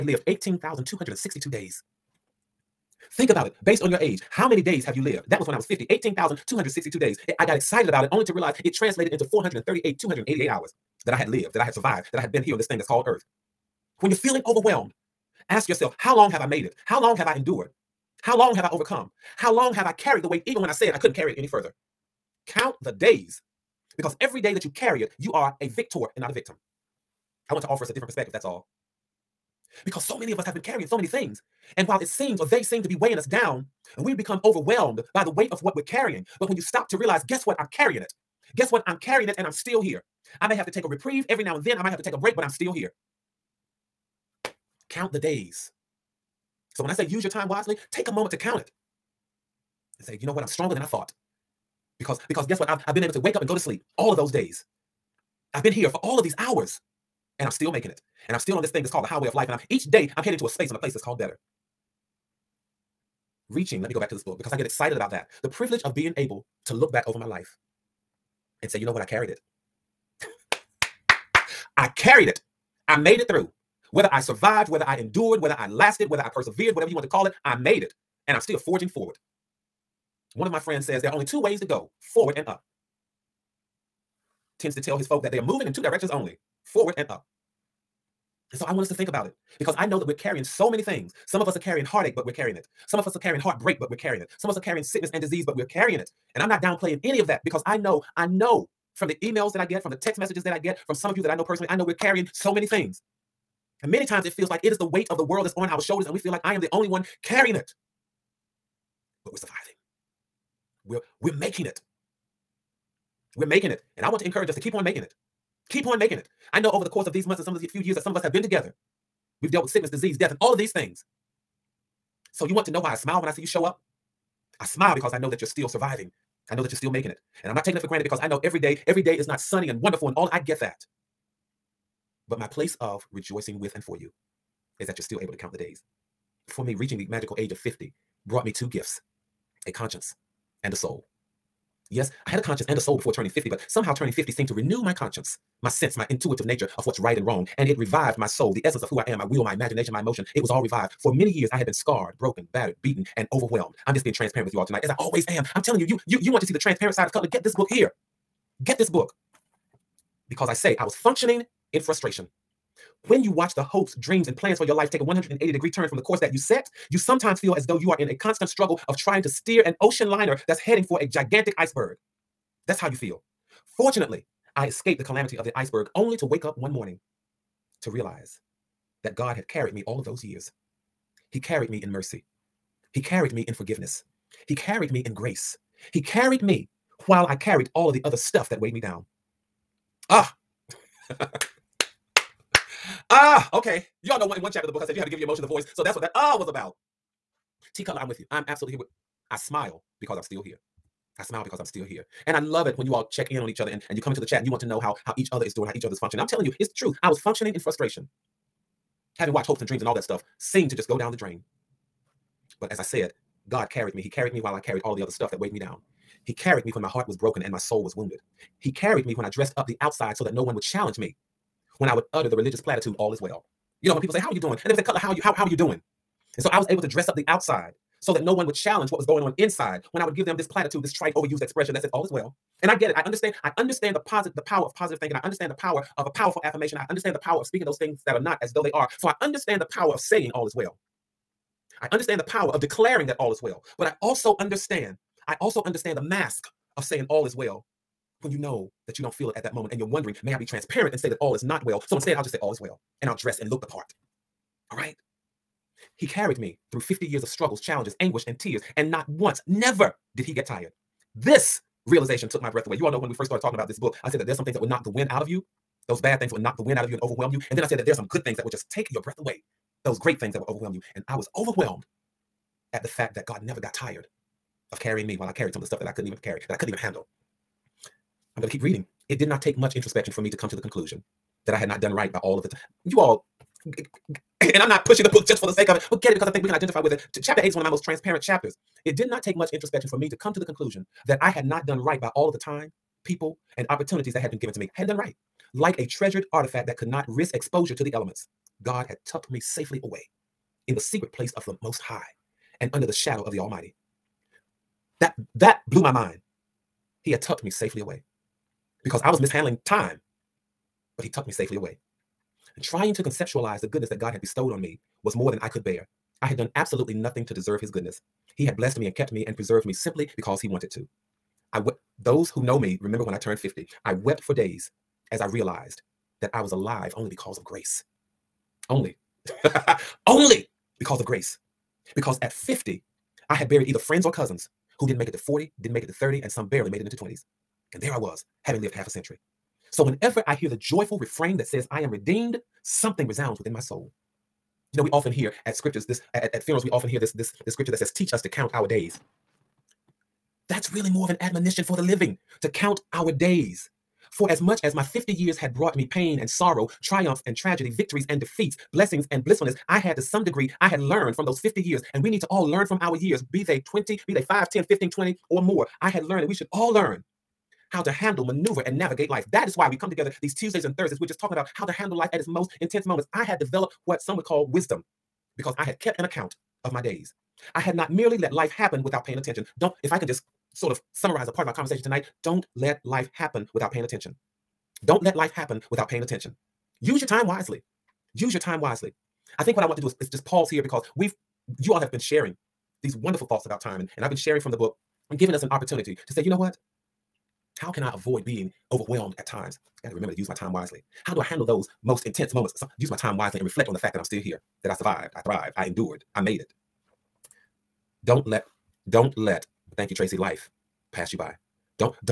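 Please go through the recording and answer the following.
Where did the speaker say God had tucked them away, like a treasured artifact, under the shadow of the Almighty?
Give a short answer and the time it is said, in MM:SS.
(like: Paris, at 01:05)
the secret place of the Most High, at 05:00.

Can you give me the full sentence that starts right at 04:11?
So instead, I'll just say all is well and I'll dress and look the part.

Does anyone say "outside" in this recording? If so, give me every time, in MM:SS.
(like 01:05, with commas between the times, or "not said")
03:39, 03:47.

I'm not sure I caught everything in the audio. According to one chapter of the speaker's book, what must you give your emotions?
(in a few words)
a voice.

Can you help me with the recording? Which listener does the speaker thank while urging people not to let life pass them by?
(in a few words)
Tracy.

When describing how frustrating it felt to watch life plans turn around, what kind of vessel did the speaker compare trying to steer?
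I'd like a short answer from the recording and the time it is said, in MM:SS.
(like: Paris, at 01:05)
ocean liner, at 02:49.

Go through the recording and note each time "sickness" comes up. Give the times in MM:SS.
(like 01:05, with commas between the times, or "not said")
01:34, 01:59.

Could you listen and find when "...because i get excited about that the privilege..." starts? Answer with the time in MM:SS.
01:04.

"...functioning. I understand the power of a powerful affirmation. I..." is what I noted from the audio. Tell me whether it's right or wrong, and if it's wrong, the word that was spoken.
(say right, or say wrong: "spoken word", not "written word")
wrong: "thinking", not "functioning".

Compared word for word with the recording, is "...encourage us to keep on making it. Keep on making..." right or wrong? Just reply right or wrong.
right.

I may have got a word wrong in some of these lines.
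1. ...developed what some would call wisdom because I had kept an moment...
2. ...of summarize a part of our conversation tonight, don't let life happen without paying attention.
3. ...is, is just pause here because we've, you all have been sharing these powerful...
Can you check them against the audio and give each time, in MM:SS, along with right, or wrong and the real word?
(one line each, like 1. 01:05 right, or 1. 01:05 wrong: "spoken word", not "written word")
1. 06:13 wrong: "account", not "moment"
2. 06:20 right
3. 06:29 wrong: "wonderful", not "powerful".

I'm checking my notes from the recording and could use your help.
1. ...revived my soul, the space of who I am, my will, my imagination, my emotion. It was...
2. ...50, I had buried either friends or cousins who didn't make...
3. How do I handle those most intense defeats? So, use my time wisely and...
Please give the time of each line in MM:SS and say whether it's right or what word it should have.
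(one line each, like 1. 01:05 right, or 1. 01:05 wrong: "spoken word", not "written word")
1. 02:27 wrong: "essence", not "space"
2. 05:32 right
3. 06:41 wrong: "moments", not "defeats".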